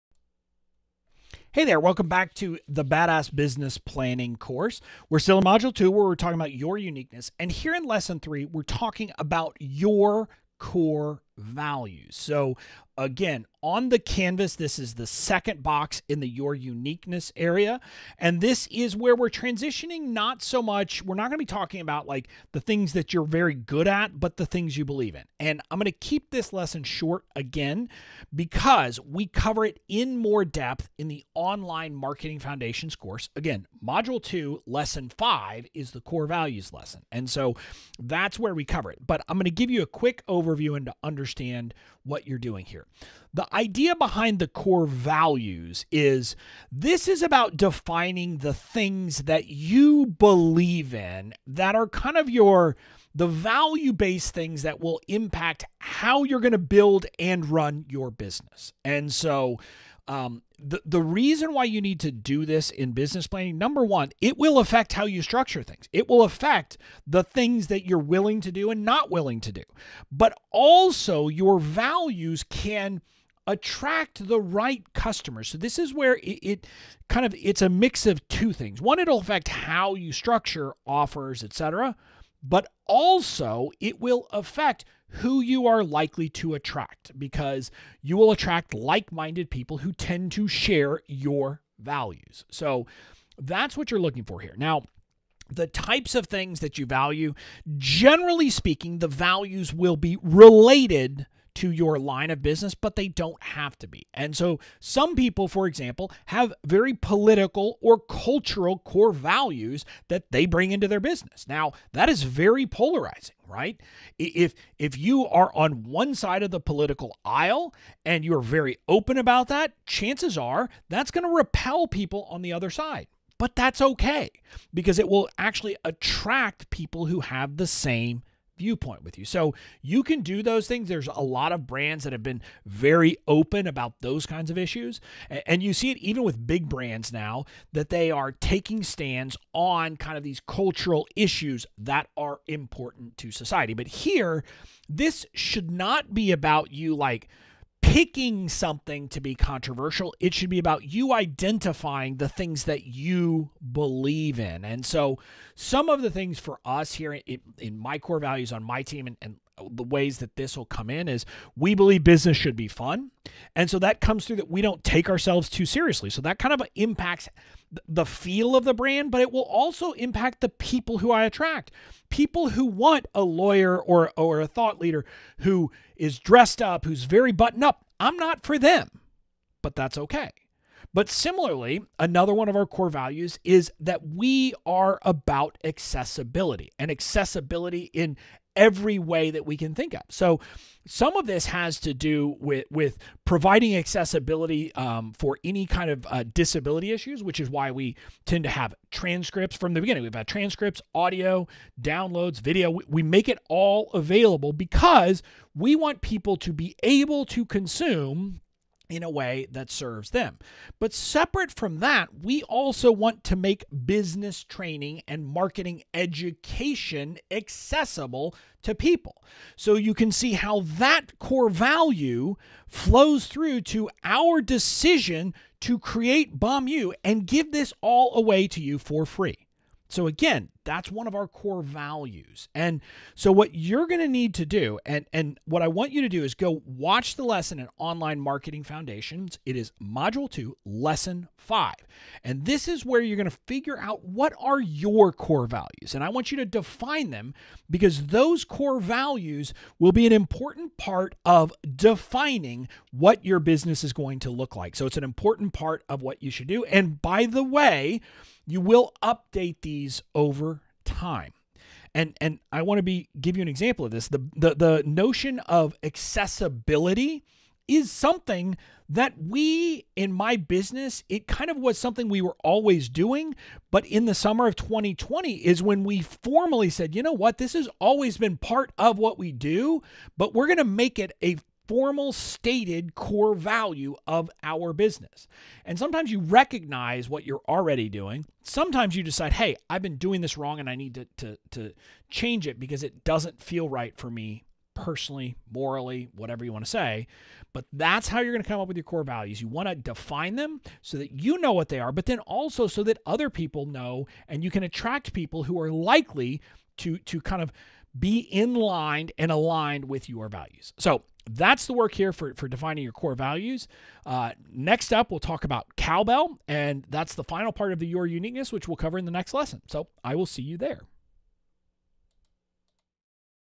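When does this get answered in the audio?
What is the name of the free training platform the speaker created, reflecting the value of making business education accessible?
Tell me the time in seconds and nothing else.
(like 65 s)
226 s.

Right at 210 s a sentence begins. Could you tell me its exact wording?
But separate from that, we also want to make business training and marketing education accessible to people.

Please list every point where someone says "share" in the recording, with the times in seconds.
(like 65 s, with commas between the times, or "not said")
90 s.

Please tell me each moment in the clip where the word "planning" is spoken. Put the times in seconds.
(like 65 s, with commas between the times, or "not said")
3 s, 63 s.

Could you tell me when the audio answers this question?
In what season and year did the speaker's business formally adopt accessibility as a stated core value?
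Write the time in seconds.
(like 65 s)
274 s.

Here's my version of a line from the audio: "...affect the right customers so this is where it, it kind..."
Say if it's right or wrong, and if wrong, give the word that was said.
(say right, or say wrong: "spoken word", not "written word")
wrong: "attract", not "affect".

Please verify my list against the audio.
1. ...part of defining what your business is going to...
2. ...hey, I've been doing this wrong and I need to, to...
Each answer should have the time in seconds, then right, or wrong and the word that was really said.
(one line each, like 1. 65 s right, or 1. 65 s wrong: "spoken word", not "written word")
1. 250 s right
2. 289 s right.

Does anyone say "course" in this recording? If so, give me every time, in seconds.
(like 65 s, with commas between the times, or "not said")
4 s, 32 s.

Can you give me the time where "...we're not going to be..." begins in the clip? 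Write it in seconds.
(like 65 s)
21 s.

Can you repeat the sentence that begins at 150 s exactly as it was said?
It should be about you identifying the things that you believe in.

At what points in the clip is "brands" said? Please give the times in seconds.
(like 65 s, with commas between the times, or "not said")
131 s, 136 s, 168 s.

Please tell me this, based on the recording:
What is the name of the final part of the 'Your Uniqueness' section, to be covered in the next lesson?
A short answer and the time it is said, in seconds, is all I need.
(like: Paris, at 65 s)
cowbell, at 315 s.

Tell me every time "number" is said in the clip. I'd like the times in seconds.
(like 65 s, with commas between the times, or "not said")
63 s.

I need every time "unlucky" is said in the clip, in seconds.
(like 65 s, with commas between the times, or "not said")
not said.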